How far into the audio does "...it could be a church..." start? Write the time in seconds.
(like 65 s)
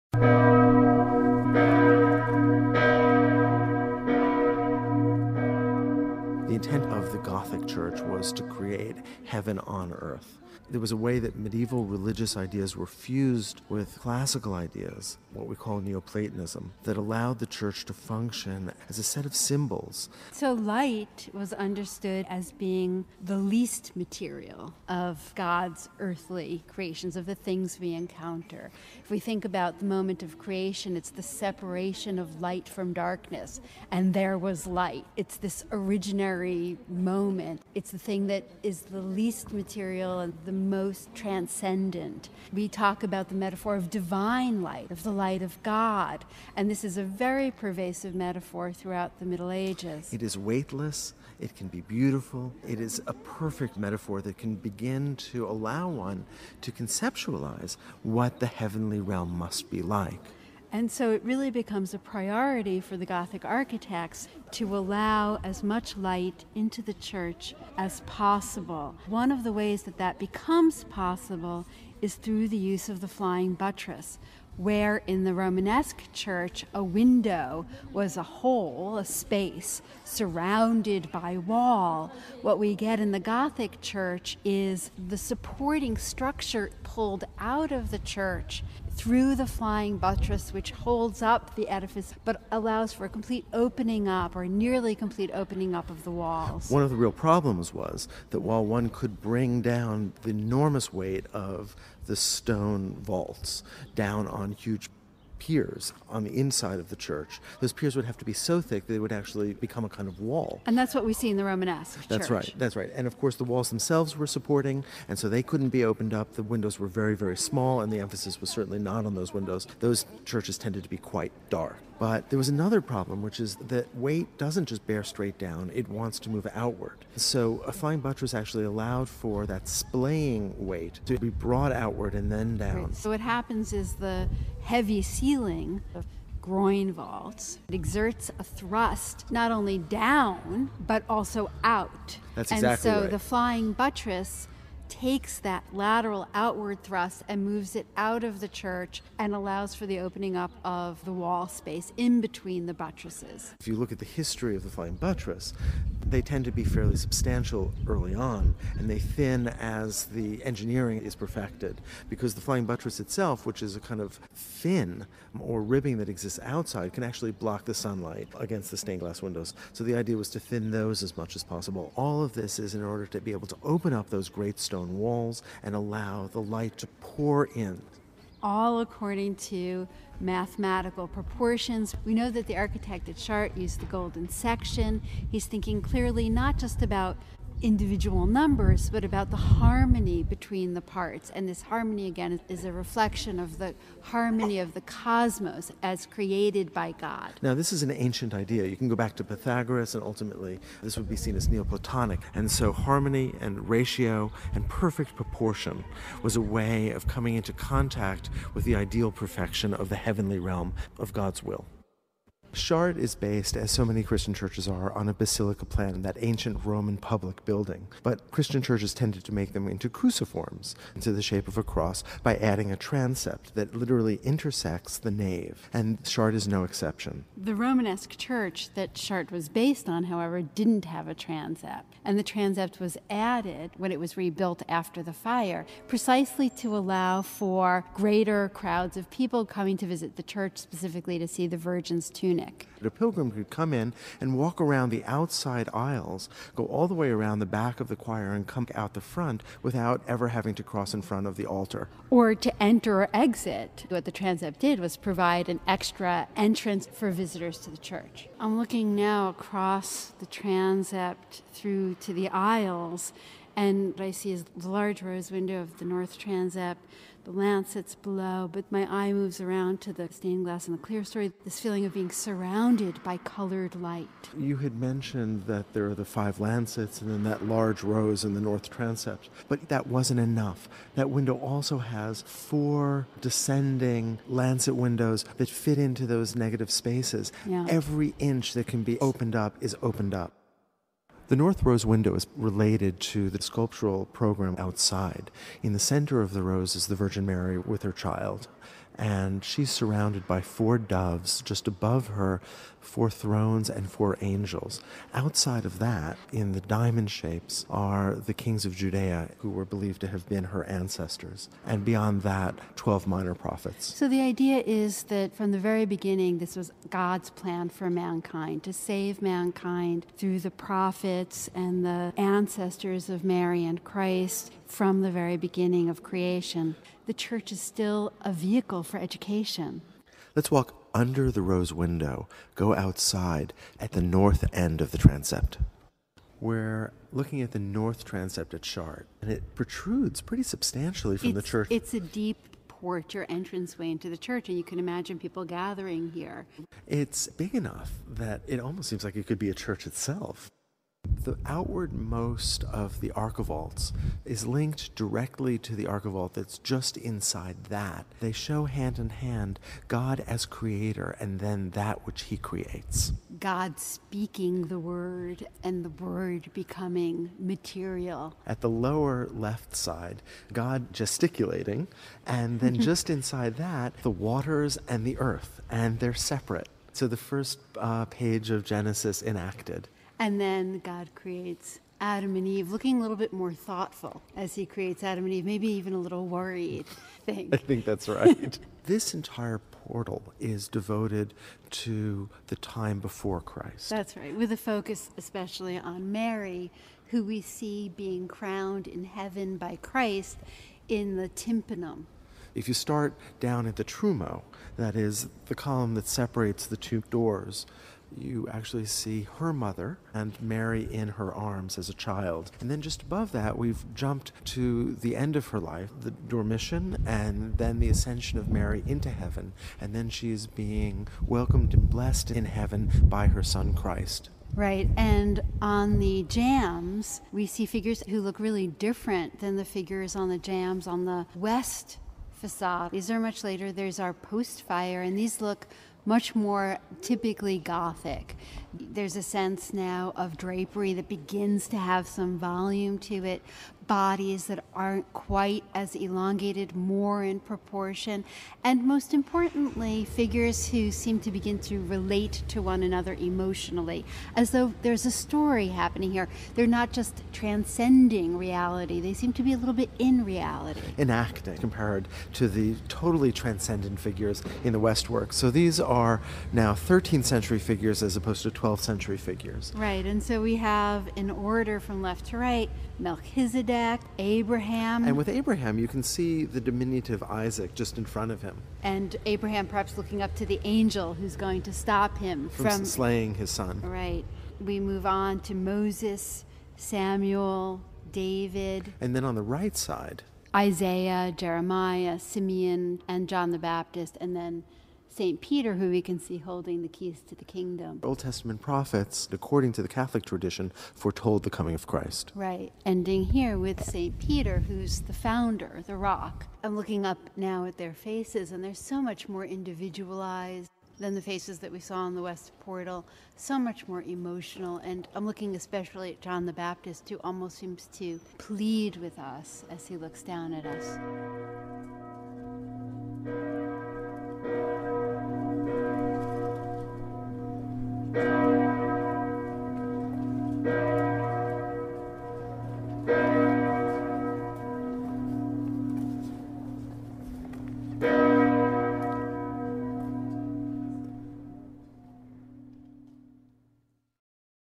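349 s.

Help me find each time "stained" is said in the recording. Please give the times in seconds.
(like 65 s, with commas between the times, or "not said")
168 s, 270 s.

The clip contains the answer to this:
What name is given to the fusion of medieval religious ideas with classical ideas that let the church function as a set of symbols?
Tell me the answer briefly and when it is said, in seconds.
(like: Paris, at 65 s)
Neoplatonism, at 15 s.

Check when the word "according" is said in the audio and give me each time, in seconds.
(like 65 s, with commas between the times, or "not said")
178 s, 499 s.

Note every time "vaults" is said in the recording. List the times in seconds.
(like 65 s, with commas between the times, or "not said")
103 s, 136 s.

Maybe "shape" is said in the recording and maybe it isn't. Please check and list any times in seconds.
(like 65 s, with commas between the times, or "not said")
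221 s, 307 s.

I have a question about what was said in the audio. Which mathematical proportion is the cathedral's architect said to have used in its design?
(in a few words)
golden section.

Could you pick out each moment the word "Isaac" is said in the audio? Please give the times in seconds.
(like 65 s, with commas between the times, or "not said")
477 s.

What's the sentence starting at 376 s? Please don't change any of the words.
So the first uh, page of Genesis enacted.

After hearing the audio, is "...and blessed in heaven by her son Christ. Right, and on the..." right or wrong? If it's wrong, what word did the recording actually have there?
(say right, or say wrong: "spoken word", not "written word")
right.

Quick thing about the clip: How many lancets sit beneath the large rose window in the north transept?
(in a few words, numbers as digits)
5.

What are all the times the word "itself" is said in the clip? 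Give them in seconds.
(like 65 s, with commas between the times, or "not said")
162 s, 349 s.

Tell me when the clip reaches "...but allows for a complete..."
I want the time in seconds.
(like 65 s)
92 s.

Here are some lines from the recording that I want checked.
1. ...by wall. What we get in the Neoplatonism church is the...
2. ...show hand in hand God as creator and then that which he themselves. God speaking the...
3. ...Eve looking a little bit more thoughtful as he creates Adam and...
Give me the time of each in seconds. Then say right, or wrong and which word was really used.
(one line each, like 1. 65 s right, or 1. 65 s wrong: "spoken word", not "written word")
1. 81 s wrong: "Gothic", not "Neoplatonism"
2. 358 s wrong: "creates", not "themselves"
3. 382 s right.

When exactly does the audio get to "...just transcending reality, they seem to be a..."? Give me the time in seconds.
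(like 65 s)
456 s.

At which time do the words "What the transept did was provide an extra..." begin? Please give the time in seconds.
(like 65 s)
253 s.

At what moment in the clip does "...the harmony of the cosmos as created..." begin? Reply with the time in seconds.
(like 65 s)
193 s.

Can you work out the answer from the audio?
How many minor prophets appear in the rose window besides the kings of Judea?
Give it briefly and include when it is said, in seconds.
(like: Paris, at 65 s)
12, at 312 s.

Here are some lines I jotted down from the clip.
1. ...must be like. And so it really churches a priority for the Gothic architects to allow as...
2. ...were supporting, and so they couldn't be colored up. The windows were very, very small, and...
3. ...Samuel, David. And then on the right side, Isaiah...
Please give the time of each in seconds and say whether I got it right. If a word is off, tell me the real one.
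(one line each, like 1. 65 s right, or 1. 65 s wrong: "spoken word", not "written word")
1. 59 s wrong: "becomes", not "churches"
2. 114 s wrong: "opened", not "colored"
3. 486 s right.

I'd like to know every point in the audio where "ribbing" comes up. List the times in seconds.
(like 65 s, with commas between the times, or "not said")
165 s.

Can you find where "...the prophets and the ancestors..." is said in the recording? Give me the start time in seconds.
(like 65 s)
320 s.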